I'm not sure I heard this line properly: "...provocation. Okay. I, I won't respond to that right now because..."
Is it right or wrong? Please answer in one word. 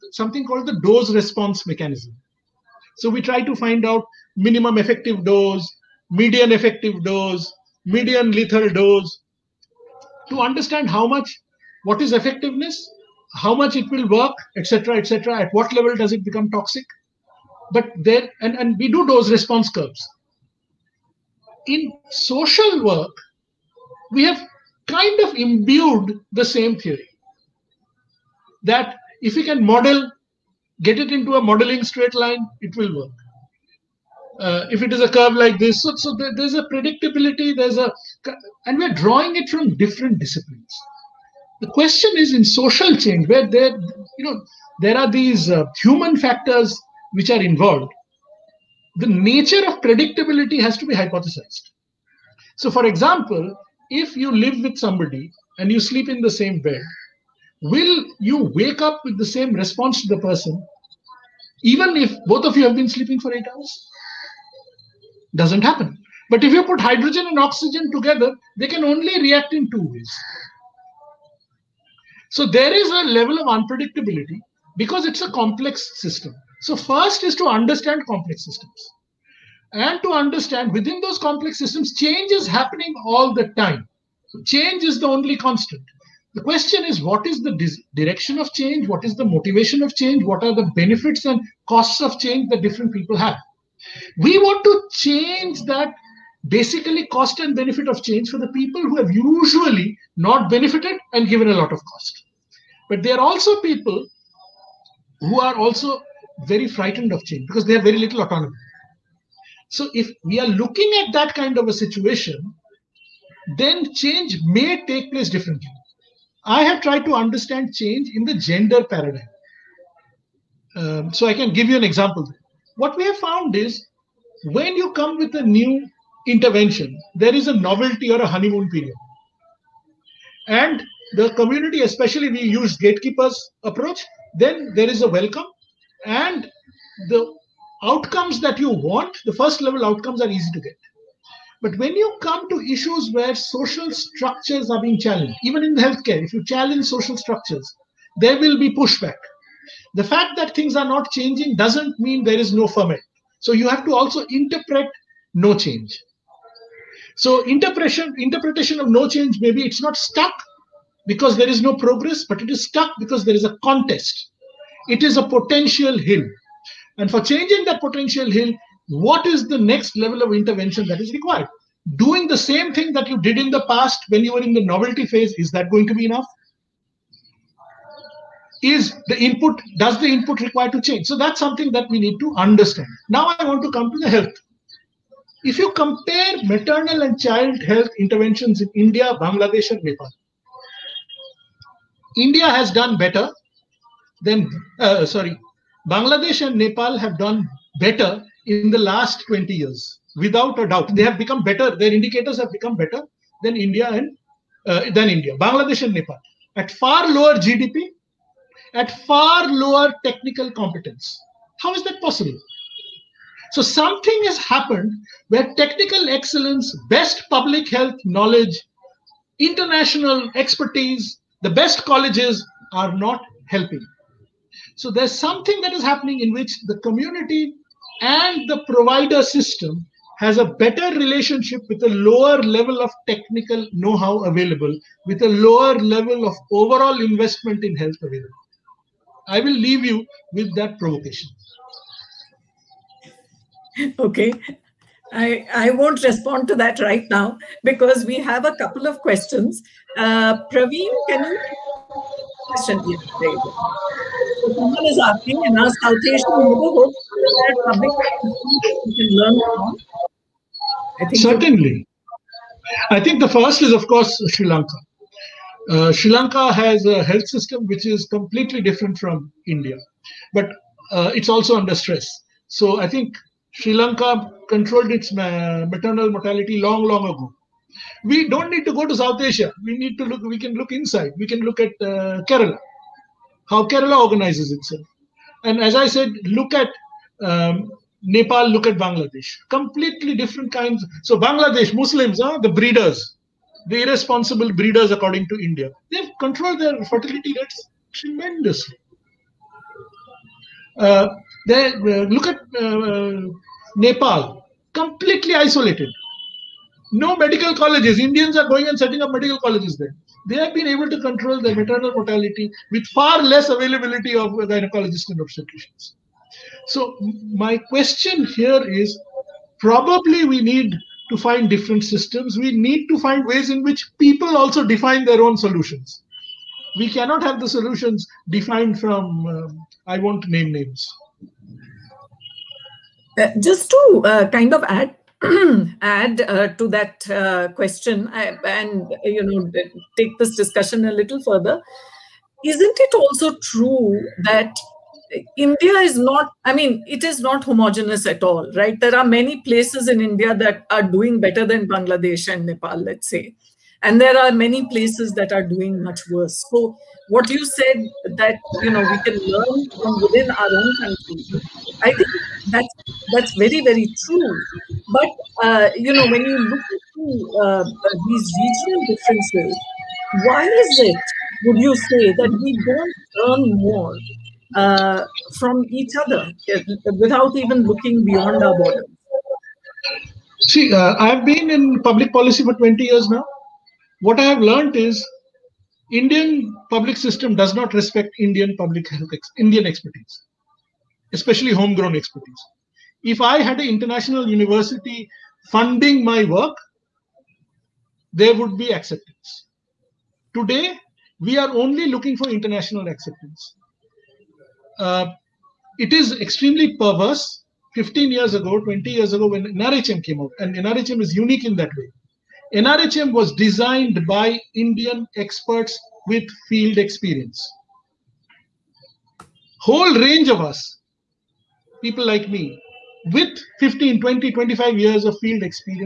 right.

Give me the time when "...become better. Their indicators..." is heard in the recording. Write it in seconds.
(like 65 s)
201 s.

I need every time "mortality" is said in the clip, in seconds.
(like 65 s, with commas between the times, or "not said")
276 s, 311 s.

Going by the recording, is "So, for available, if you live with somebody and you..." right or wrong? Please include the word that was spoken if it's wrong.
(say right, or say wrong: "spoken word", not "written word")
wrong: "example", not "available".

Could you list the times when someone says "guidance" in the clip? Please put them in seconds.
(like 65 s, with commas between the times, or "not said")
not said.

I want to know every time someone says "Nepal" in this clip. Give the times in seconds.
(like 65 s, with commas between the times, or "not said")
189 s, 196 s, 205 s, 288 s, 303 s, 352 s.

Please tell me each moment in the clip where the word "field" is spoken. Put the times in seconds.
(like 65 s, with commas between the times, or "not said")
416 s, 425 s.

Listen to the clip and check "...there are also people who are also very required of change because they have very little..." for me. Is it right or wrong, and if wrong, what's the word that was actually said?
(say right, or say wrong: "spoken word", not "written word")
wrong: "frightened", not "required".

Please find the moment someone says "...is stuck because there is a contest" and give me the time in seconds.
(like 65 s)
162 s.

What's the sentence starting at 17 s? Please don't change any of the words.
But there, and, and we do dose response curves.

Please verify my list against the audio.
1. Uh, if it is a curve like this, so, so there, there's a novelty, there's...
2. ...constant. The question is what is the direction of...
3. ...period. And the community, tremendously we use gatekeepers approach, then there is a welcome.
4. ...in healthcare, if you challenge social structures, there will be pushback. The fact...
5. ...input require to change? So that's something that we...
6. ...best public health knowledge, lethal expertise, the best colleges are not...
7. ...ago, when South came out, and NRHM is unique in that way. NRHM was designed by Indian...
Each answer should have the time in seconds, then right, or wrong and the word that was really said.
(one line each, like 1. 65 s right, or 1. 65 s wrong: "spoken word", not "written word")
1. 34 s wrong: "predictability", not "novelty"
2. 85 s right
3. 128 s wrong: "especially", not "tremendously"
4. 145 s right
5. 180 s right
6. 216 s wrong: "international", not "lethal"
7. 409 s wrong: "NRHM", not "South".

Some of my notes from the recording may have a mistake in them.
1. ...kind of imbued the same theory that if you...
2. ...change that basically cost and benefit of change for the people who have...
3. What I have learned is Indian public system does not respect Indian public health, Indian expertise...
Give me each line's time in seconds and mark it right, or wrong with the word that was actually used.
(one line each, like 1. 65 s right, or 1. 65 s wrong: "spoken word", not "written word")
1. 24 s right
2. 94 s right
3. 384 s right.